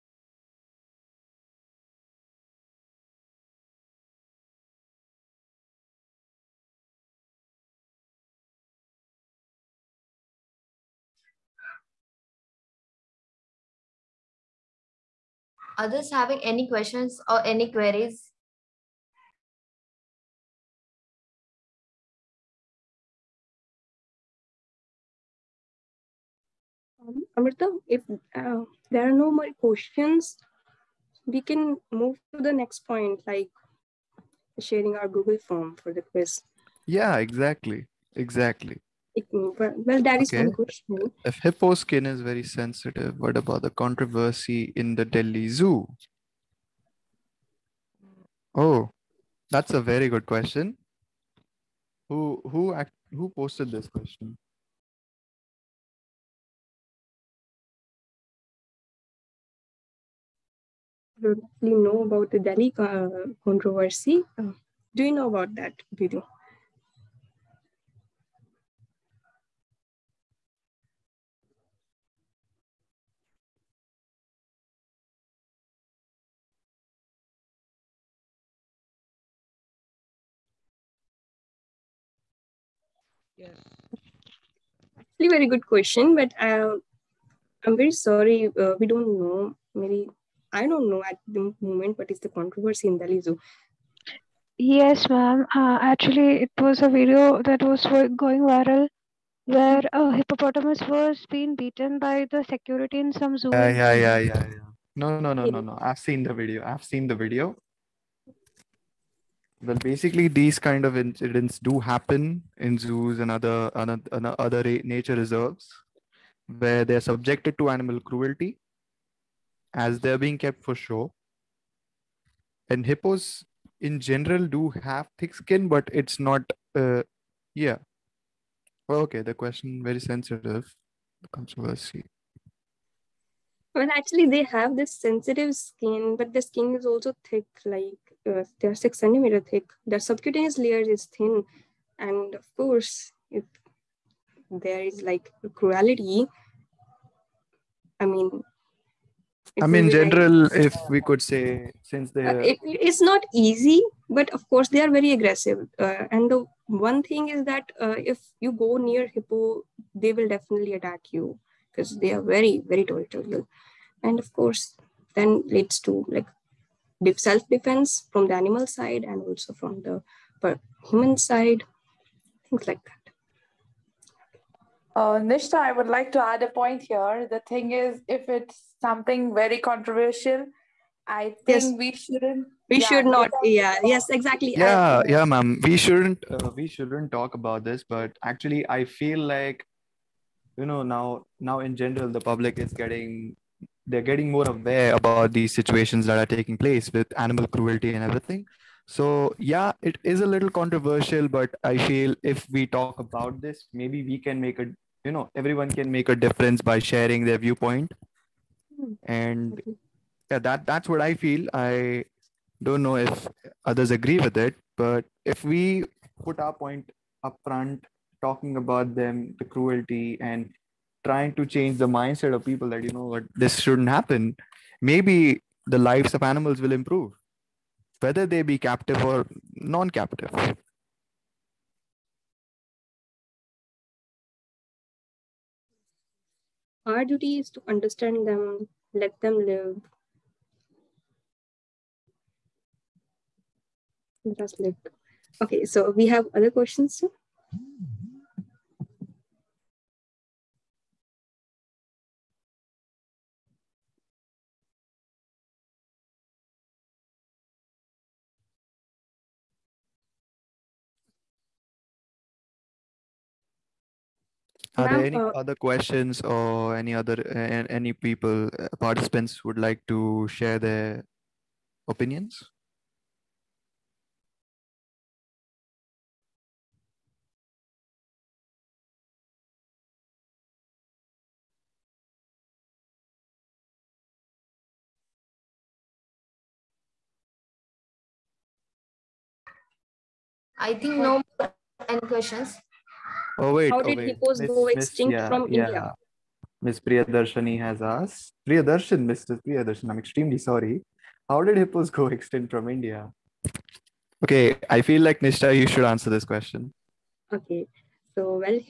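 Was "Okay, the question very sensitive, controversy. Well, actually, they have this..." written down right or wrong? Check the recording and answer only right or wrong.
right.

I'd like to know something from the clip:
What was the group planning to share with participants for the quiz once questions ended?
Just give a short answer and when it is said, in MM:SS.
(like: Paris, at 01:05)
Google form, at 00:35.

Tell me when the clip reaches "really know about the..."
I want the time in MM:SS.
01:01.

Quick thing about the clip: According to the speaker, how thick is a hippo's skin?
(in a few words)
6 centimeters.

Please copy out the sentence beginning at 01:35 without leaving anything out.
Uh, actually, it was a video that was going viral where a hippopotamus was being beaten by the security in some zoo.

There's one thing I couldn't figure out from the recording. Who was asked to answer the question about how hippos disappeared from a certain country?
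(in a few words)
Nishtha.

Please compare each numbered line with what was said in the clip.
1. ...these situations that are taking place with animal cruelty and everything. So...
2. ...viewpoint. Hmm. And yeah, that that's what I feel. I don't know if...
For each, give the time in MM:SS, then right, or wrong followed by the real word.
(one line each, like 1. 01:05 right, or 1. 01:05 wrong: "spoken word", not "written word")
1. 03:15 right
2. 03:27 right.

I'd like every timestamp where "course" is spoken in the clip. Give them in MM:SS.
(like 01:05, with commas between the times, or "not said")
02:22, 02:34, 02:44.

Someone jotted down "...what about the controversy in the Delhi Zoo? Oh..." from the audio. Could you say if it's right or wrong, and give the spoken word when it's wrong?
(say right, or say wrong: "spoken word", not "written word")
right.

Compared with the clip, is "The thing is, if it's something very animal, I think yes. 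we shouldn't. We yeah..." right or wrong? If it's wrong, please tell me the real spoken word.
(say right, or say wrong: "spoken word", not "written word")
wrong: "controversial", not "animal".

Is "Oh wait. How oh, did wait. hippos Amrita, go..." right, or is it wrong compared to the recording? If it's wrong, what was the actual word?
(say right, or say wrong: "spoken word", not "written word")
wrong: "Miss", not "Amrita".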